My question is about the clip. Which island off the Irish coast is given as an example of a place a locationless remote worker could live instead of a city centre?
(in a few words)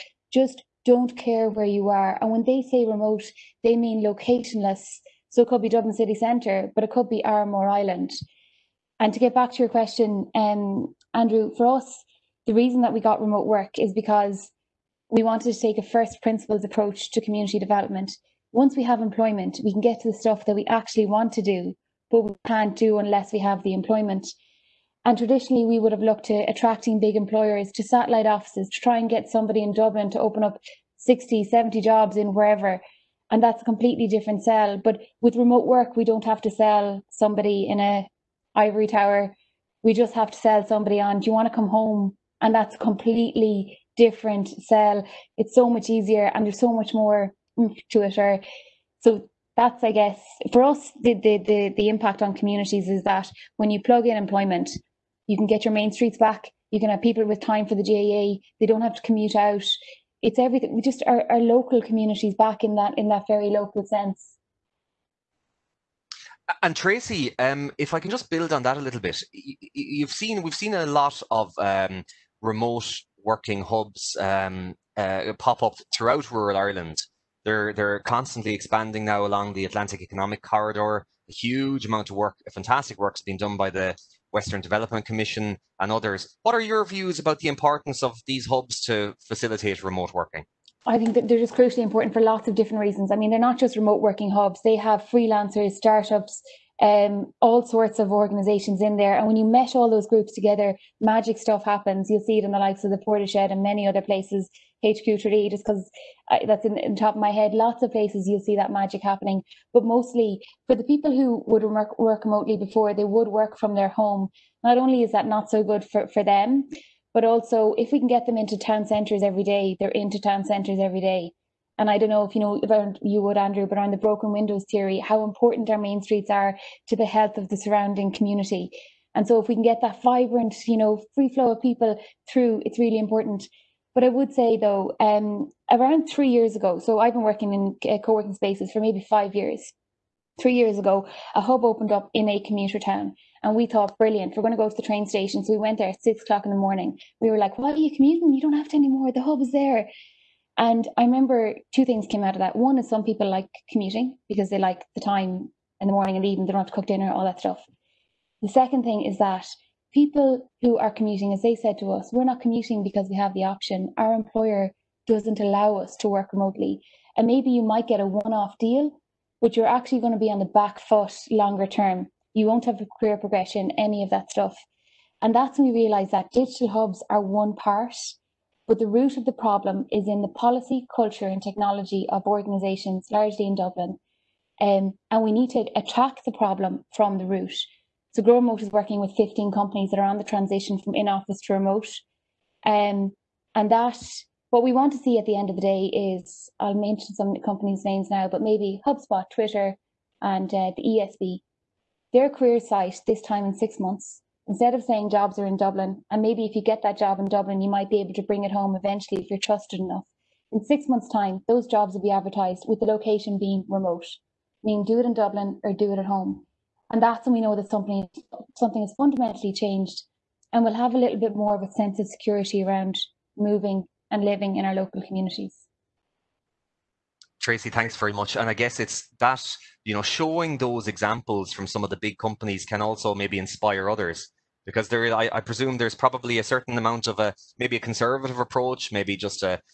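Arranmore Island.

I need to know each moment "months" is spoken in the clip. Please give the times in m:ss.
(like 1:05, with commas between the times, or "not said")
3:23, 3:30.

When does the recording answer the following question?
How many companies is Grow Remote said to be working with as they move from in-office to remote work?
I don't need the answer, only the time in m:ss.
3:09.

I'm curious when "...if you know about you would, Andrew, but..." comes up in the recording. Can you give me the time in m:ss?
2:02.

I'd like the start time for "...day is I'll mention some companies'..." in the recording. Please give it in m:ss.
3:15.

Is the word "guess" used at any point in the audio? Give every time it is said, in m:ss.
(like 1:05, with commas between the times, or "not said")
0:49, 3:48.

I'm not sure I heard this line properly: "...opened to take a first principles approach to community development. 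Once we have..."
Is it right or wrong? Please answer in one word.
wrong.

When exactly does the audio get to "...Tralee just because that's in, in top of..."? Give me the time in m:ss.
1:45.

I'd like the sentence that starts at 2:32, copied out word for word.
One is some people like commuting because they like the time in the morning and the evening.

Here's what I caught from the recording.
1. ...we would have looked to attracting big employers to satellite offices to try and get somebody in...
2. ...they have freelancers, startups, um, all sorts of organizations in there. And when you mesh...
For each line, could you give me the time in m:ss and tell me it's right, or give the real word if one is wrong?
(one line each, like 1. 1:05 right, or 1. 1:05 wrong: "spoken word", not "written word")
1. 0:25 right
2. 1:34 right.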